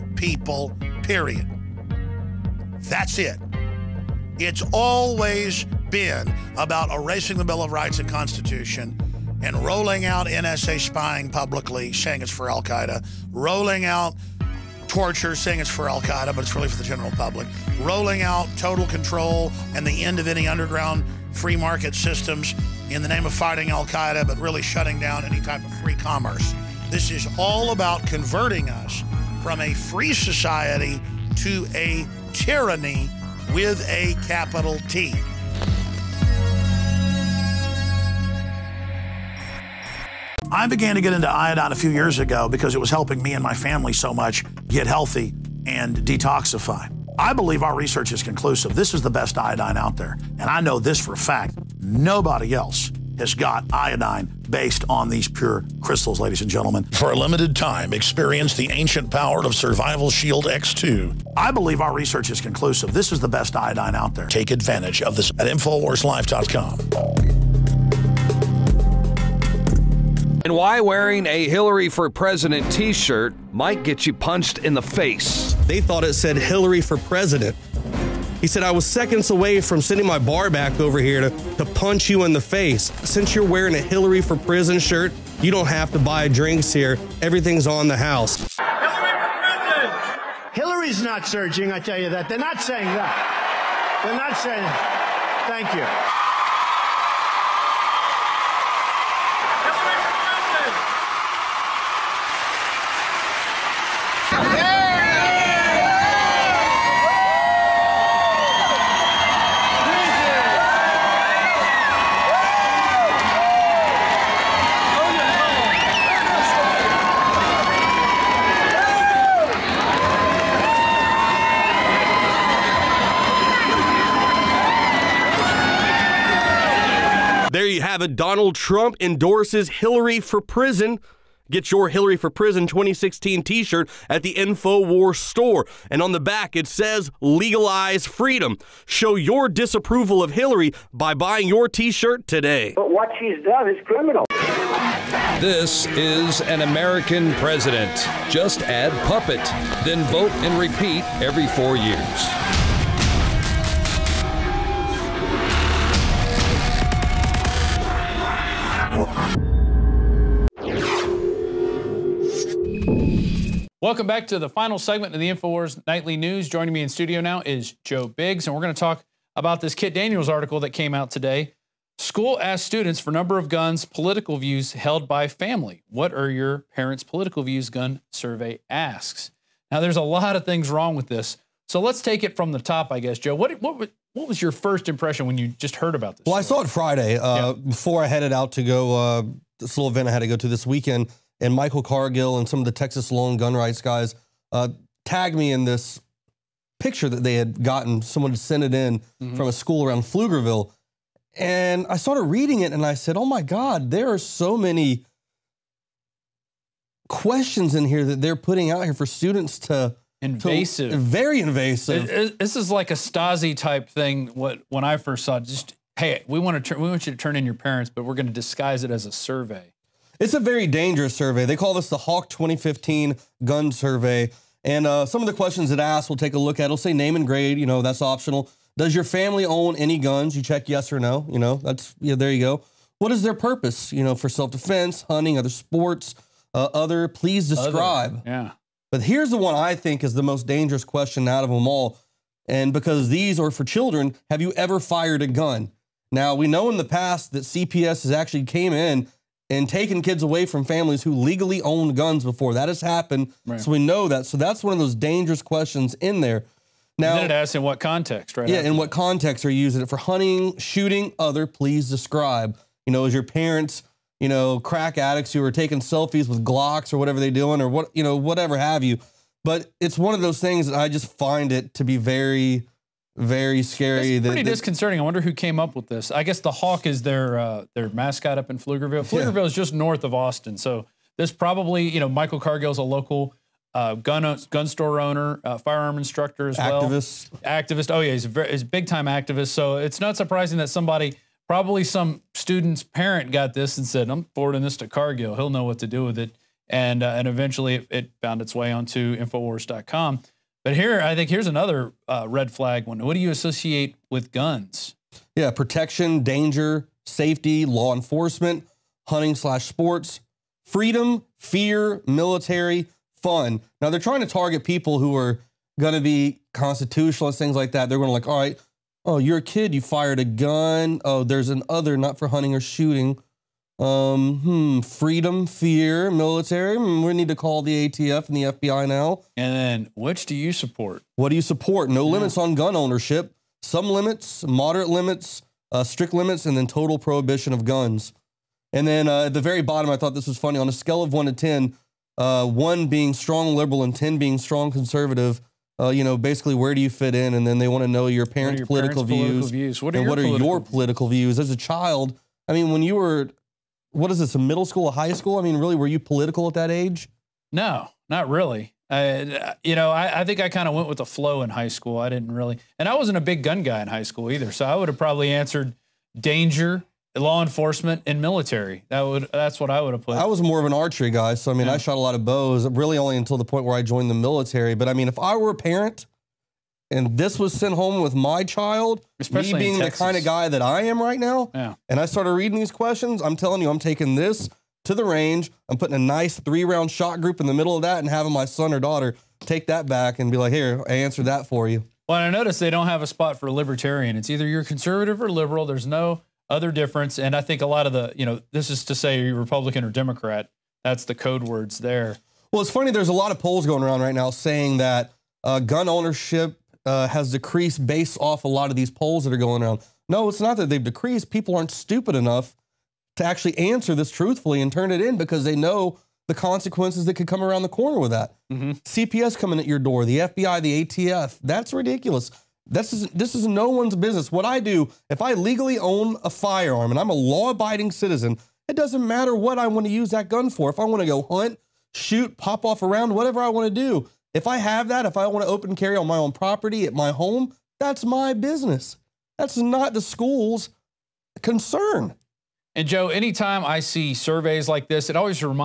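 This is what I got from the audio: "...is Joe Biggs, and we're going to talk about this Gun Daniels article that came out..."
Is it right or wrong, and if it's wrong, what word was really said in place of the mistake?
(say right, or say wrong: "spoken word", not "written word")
wrong: "Kit", not "Gun".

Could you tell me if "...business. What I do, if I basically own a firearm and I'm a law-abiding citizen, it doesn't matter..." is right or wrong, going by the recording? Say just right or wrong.
wrong.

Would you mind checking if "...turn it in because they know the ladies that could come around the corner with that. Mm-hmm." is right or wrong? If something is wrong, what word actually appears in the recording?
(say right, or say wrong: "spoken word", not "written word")
wrong: "consequences", not "ladies".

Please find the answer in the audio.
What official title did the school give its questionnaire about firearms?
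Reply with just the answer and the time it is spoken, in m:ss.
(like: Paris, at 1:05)
Hawk 2015 Gun Survey, at 3:41.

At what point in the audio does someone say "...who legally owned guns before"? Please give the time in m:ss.
4:11.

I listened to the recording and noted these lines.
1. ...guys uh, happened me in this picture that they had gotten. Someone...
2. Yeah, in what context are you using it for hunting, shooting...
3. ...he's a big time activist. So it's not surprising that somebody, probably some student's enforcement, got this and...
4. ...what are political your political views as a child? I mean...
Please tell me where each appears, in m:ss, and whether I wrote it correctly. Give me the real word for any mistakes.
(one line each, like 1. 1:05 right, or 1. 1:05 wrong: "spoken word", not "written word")
1. 3:13 wrong: "tagged", not "happened"
2. 4:18 right
3. 4:48 wrong: "parent", not "enforcement"
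4. 5:50 right.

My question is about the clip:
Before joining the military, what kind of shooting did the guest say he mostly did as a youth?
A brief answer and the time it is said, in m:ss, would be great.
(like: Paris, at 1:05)
archery, at 6:10.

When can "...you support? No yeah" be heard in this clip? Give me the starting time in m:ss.
5:31.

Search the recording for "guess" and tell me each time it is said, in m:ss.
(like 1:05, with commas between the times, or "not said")
3:02, 4:36.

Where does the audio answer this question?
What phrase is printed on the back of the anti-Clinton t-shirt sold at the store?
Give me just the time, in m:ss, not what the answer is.
2:17.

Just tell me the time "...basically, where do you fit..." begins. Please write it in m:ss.
5:46.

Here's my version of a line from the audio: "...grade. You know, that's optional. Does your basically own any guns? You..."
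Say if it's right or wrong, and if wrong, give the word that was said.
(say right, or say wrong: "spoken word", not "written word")
wrong: "family", not "basically".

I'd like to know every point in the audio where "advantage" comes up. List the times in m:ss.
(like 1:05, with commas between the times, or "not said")
1:04.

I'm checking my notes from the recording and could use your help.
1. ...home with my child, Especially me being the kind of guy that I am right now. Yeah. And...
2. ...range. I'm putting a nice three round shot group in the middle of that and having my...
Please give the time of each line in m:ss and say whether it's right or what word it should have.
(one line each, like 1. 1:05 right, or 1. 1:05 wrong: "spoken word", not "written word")
1. 6:17 right
2. 6:25 right.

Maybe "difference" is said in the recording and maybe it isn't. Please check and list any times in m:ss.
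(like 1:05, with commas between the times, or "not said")
6:36.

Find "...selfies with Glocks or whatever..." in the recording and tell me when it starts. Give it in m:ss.
4:25.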